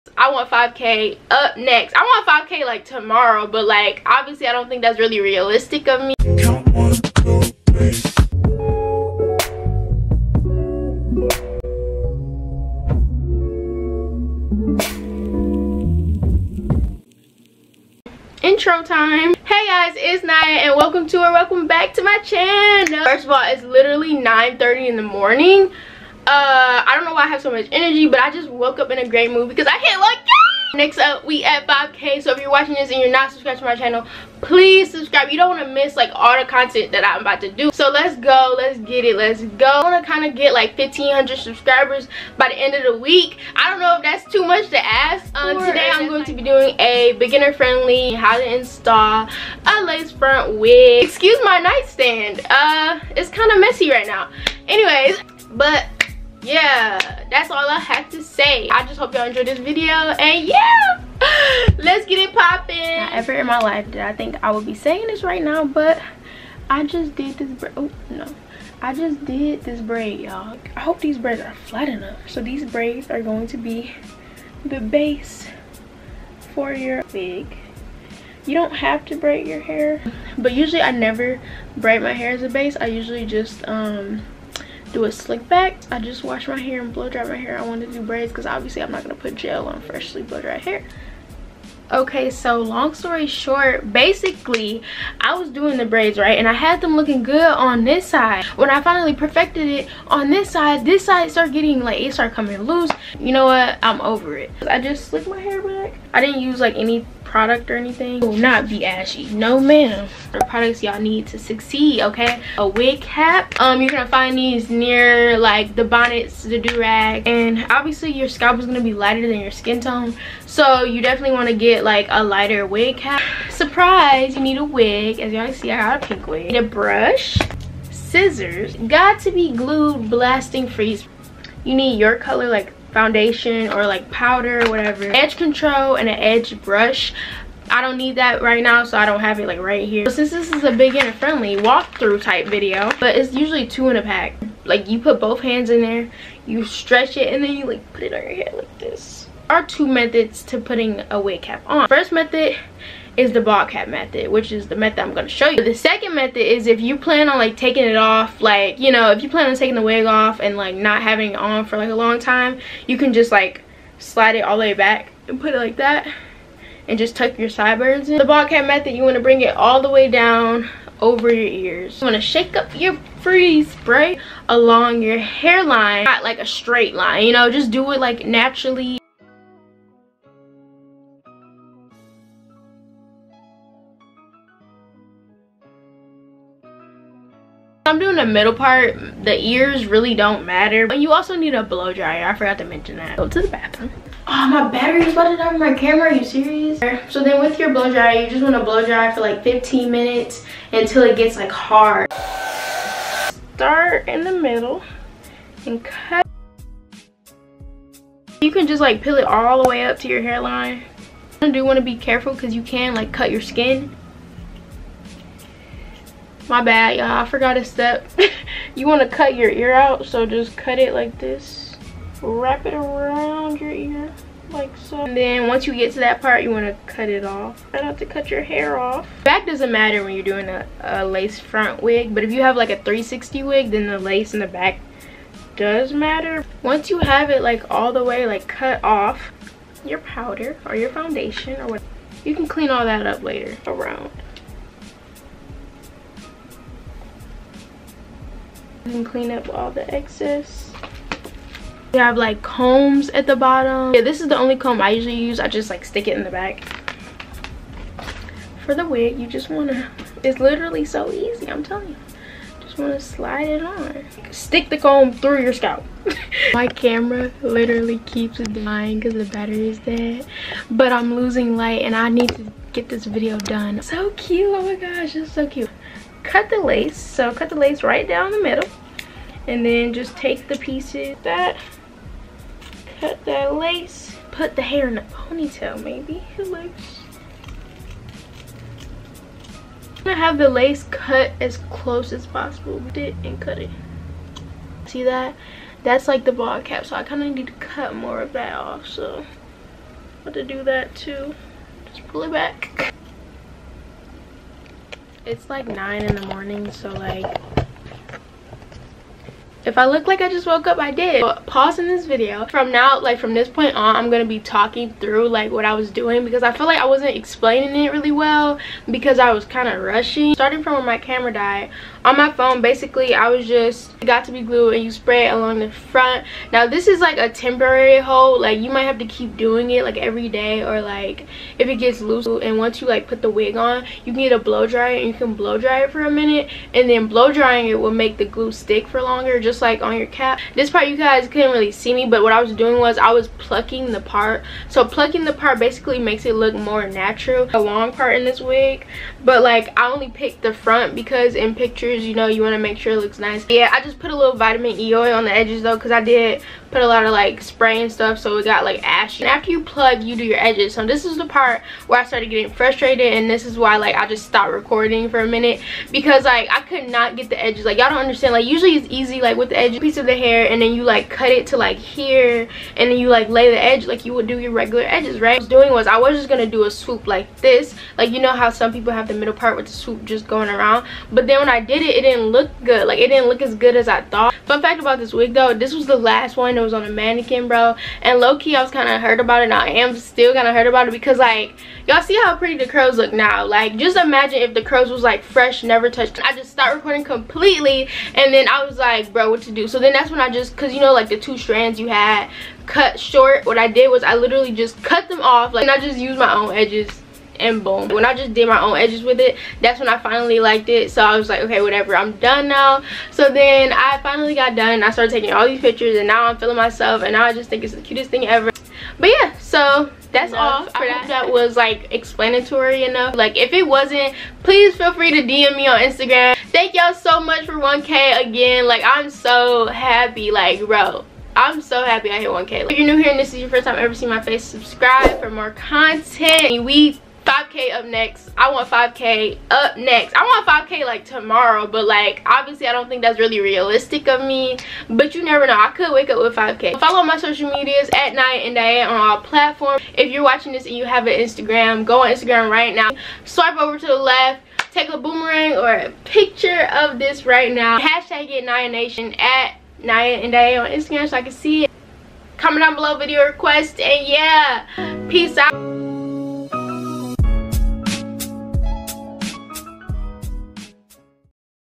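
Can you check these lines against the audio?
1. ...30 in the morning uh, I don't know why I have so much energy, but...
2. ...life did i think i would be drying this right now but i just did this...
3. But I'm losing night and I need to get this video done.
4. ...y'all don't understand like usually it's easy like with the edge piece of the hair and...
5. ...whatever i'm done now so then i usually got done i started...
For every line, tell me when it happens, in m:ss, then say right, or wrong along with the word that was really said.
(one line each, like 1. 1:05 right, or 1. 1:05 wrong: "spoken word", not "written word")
1. 0:24 right
2. 1:03 wrong: "saying", not "drying"
3. 4:30 wrong: "light", not "night"
4. 6:07 right
5. 6:51 wrong: "finally", not "usually".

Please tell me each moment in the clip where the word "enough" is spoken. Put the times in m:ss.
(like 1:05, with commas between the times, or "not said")
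1:11, 7:02.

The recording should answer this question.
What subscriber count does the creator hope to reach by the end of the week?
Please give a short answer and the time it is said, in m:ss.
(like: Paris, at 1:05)
1,500, at 0:40.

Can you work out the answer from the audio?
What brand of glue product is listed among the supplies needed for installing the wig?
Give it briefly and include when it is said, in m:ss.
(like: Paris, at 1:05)
Got2b Glued, at 2:08.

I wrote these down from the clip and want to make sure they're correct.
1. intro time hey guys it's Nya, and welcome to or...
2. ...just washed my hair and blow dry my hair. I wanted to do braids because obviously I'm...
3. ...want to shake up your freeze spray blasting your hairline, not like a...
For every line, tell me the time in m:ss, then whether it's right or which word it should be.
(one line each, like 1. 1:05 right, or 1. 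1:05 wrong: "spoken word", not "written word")
1. 0:18 right
2. 1:25 right
3. 2:52 wrong: "along", not "blasting".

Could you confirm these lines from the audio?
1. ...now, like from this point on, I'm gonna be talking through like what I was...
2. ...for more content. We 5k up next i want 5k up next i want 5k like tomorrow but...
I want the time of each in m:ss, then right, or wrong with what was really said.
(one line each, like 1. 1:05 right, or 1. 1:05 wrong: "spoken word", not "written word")
1. 5:12 right
2. 7:15 right.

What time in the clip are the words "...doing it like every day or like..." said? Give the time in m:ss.
5:29.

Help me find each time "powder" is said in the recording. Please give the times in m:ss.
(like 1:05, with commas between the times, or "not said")
2:14, 3:59.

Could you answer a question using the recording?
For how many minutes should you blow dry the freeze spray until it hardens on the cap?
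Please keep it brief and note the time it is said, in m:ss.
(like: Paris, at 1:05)
15, at 3:19.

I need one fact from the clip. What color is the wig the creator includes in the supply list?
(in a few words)
Pink.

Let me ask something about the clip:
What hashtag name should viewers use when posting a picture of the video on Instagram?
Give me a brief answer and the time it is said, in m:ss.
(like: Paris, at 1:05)
Nya nation, at 7:38.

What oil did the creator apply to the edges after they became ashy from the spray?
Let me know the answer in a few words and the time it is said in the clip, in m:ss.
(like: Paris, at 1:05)
Vitamin E oil, at 5:54.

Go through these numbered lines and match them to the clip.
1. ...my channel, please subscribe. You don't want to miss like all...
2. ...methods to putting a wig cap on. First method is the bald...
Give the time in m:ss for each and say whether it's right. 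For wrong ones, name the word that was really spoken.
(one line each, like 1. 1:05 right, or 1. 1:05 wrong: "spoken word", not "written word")
1. 0:33 right
2. 2:29 right.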